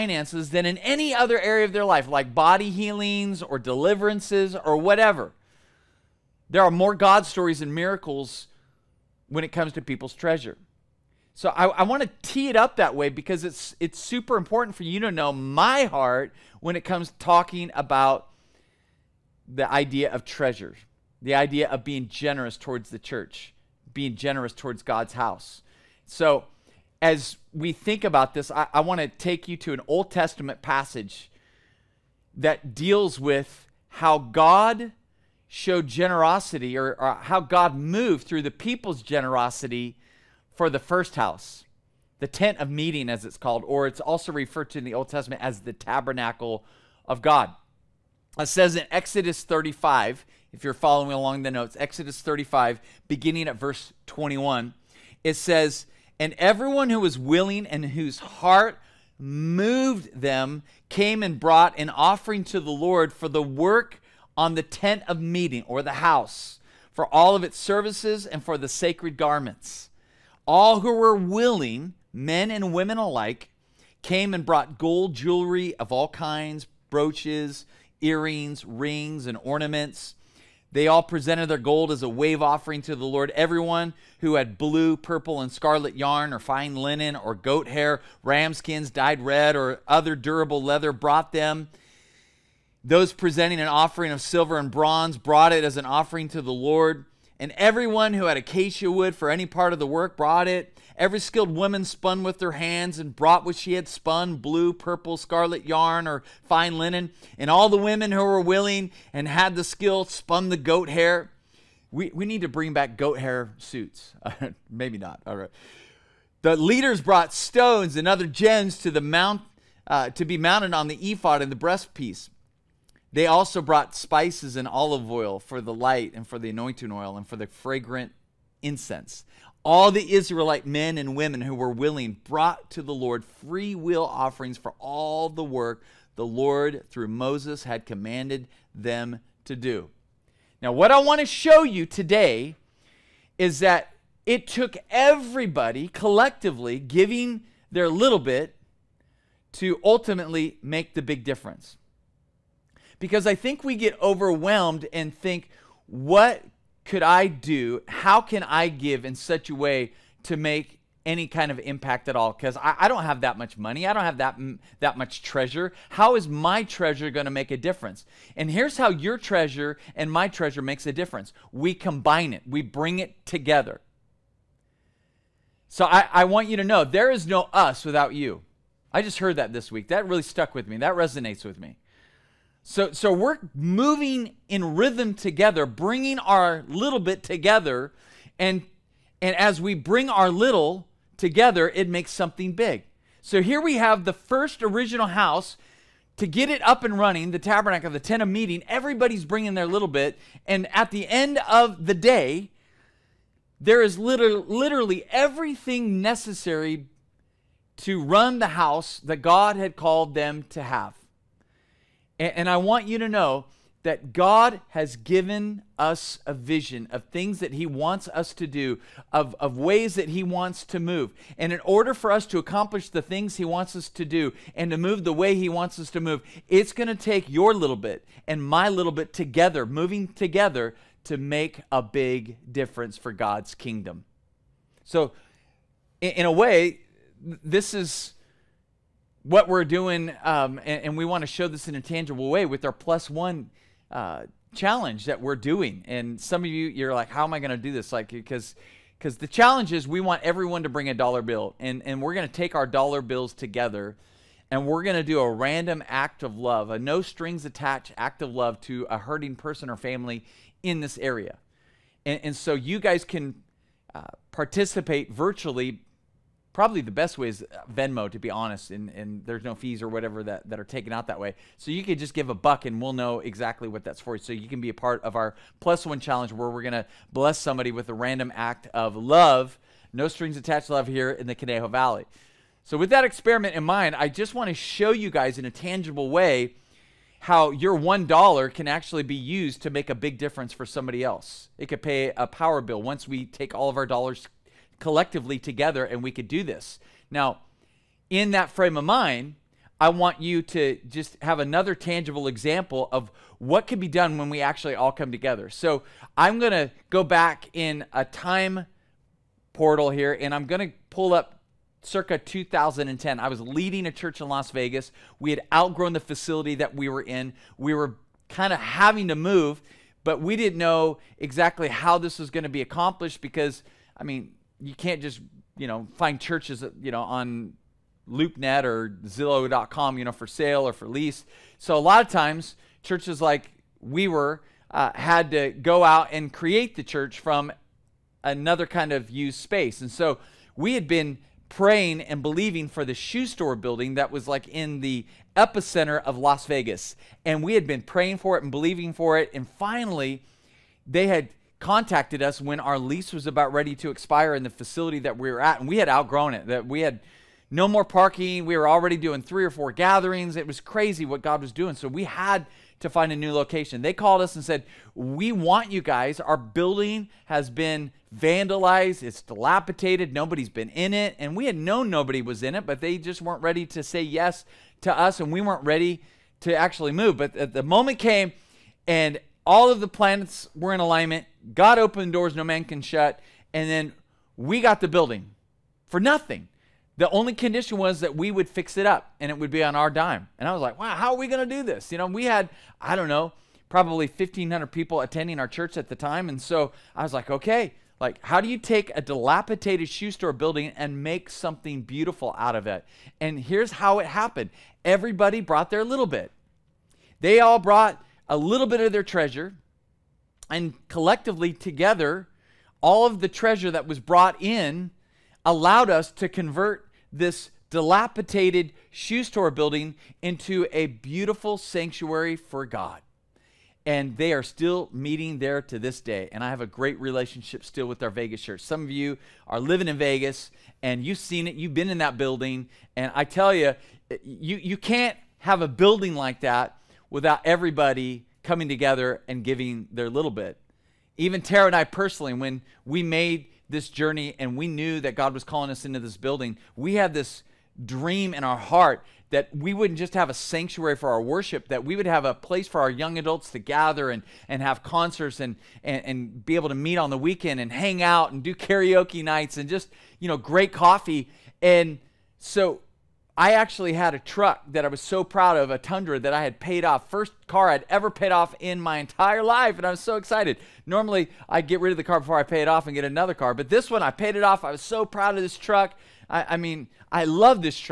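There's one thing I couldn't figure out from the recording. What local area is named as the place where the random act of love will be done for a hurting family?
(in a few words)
Conejo Valley.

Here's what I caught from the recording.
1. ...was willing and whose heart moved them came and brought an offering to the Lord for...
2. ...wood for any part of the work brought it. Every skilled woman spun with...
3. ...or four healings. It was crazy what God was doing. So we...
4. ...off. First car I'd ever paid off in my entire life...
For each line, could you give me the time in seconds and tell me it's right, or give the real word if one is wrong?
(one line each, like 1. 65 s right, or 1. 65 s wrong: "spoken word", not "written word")
1. 57 s right
2. 98 s right
3. 359 s wrong: "gatherings", not "healings"
4. 466 s right.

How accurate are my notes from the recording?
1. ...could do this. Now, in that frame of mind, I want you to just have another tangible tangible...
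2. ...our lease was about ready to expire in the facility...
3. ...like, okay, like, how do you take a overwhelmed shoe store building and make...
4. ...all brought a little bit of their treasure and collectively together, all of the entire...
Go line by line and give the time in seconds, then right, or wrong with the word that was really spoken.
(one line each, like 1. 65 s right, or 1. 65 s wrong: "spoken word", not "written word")
1. 296 s wrong: "example", not "tangible"
2. 352 s right
3. 397 s wrong: "dilapidated", not "overwhelmed"
4. 407 s wrong: "treasure", not "entire".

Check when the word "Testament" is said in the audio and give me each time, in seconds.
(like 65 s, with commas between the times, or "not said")
30 s, 45 s.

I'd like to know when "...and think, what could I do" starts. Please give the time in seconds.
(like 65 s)
154 s.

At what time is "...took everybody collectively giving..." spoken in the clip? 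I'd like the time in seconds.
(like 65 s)
144 s.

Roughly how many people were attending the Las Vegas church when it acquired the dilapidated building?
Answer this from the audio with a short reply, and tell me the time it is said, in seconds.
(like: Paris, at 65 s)
1,500, at 394 s.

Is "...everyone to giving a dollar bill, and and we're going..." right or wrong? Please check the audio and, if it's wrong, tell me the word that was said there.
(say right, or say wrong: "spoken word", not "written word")
wrong: "bring", not "giving".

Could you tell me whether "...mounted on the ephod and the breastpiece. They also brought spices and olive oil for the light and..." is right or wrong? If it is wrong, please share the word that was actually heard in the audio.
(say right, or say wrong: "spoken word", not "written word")
right.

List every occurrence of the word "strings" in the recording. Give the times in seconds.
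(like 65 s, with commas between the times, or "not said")
257 s, 280 s.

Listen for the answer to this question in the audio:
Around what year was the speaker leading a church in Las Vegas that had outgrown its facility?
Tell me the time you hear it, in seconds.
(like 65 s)
312 s.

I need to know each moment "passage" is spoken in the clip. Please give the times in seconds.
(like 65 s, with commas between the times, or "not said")
30 s.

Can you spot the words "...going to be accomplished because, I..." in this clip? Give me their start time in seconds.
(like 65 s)
322 s.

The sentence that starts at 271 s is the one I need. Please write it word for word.
So you could just give a buck and we'll know exactly what that's for.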